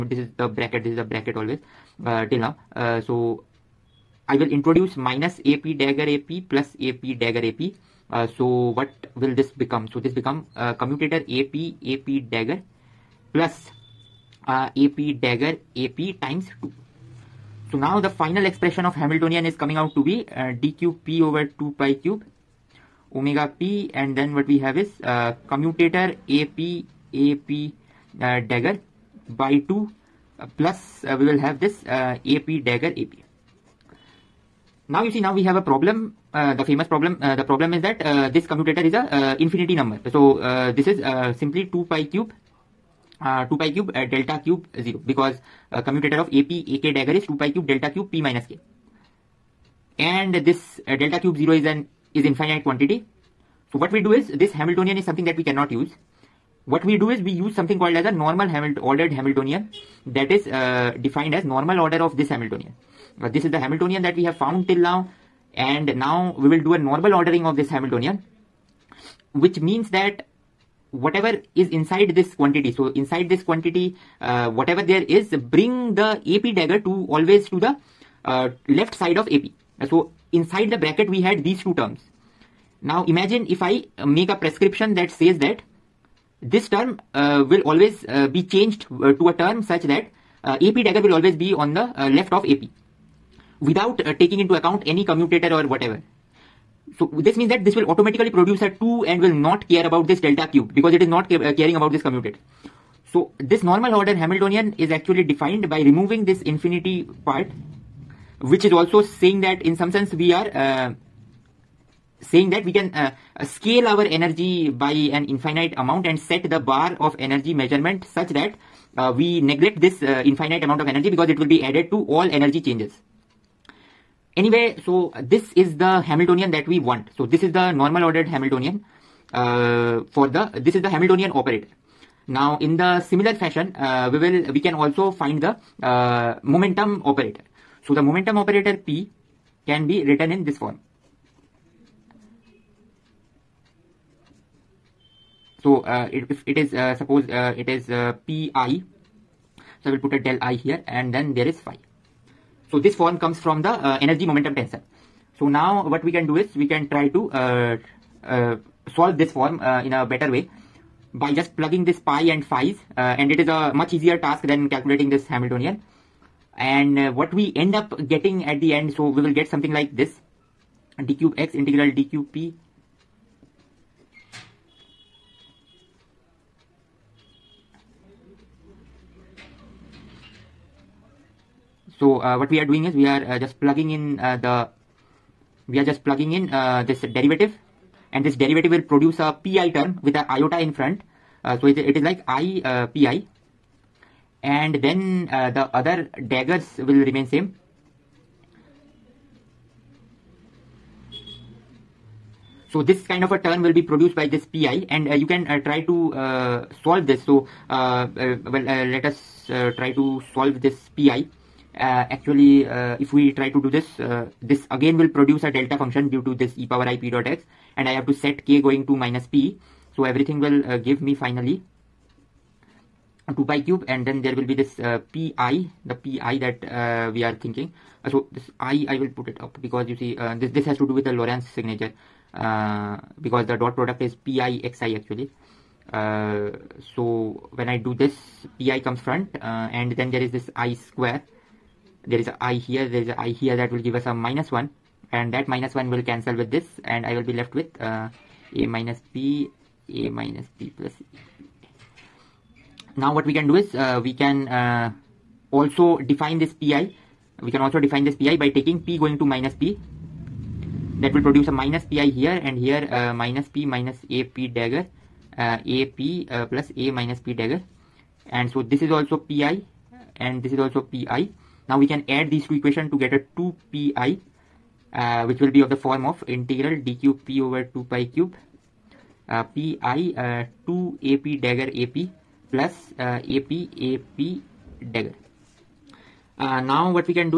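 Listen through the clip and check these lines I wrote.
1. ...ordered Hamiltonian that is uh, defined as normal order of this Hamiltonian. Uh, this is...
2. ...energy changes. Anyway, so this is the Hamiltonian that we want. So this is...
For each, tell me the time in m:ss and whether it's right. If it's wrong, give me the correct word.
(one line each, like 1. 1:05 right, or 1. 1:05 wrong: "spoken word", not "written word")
1. 0:58 right
2. 2:02 right.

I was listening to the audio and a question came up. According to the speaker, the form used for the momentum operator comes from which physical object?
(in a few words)
energy momentum tensor.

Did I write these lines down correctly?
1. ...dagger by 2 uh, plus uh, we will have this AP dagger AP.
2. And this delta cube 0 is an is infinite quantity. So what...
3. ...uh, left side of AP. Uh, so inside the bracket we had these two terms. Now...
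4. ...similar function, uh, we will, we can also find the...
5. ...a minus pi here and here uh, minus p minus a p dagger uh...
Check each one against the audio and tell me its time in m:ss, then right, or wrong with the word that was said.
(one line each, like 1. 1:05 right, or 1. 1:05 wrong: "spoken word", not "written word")
1. 0:28 right
2. 0:49 right
3. 1:18 right
4. 2:13 wrong: "fashion", not "function"
5. 4:21 right.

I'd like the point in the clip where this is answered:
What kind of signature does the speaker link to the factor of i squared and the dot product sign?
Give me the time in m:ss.
3:51.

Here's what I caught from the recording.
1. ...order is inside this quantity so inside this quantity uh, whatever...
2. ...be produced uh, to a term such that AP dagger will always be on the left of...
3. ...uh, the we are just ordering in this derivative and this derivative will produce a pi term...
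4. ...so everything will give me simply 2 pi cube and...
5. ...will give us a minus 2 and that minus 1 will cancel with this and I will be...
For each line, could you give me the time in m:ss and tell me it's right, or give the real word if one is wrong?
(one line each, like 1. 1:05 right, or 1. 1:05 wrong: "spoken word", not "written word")
1. 1:10 wrong: "whatever", not "order"
2. 1:28 wrong: "changed", not "produced"
3. 3:04 wrong: "plugging", not "ordering"
4. 3:39 wrong: "finally", not "simply"
5. 4:03 wrong: "1", not "2".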